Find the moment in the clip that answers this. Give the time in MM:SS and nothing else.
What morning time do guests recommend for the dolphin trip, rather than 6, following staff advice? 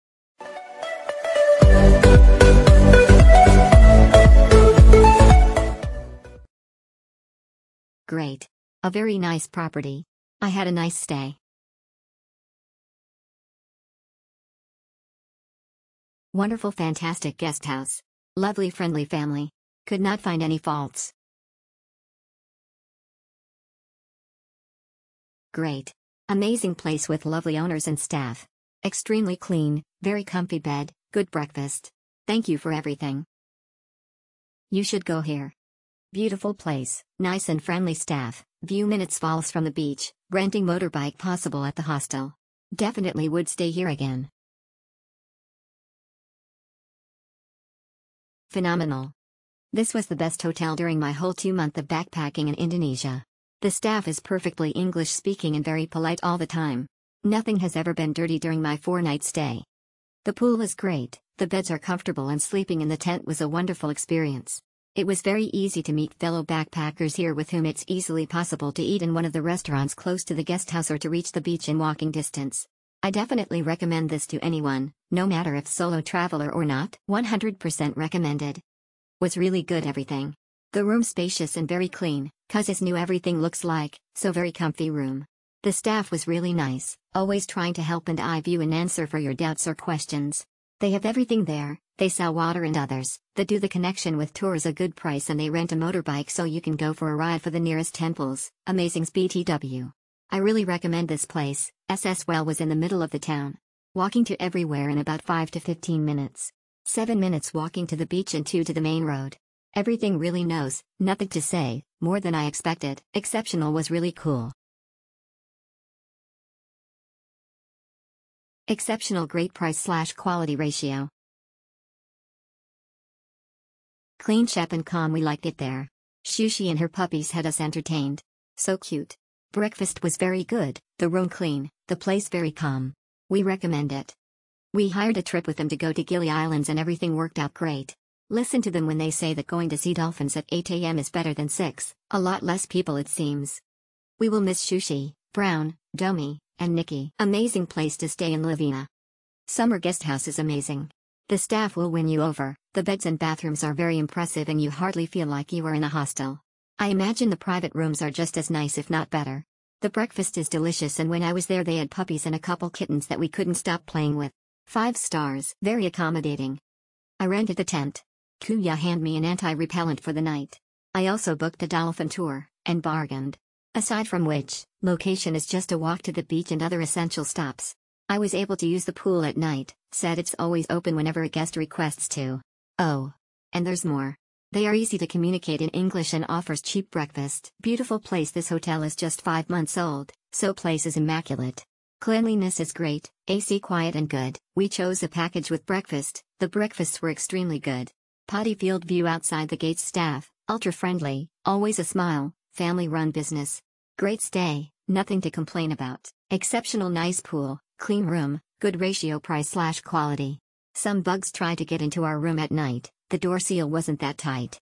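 02:20.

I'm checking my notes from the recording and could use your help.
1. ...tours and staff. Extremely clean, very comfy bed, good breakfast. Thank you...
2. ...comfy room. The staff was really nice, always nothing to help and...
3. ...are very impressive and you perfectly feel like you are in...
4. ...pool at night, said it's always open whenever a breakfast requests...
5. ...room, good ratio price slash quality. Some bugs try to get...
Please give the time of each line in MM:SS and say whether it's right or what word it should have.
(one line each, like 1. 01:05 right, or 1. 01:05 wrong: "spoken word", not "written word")
1. 00:27 wrong: "owners", not "tours"
2. 01:24 wrong: "trying", not "nothing"
3. 02:33 wrong: "hardly", not "perfectly"
4. 02:58 wrong: "guest", not "breakfast"
5. 03:28 right.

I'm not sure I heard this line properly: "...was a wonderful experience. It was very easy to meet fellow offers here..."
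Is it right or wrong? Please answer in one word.
wrong.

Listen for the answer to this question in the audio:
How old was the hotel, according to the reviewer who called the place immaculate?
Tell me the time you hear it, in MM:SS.
03:09.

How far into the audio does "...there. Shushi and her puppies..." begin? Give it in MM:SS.
02:05.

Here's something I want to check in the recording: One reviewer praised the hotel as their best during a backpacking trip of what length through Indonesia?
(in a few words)
2 months.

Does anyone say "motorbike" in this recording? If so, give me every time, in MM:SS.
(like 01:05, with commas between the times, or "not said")
00:40, 01:35.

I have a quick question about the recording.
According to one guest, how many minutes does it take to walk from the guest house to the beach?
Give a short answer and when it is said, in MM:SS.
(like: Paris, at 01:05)
7 minutes, at 01:46.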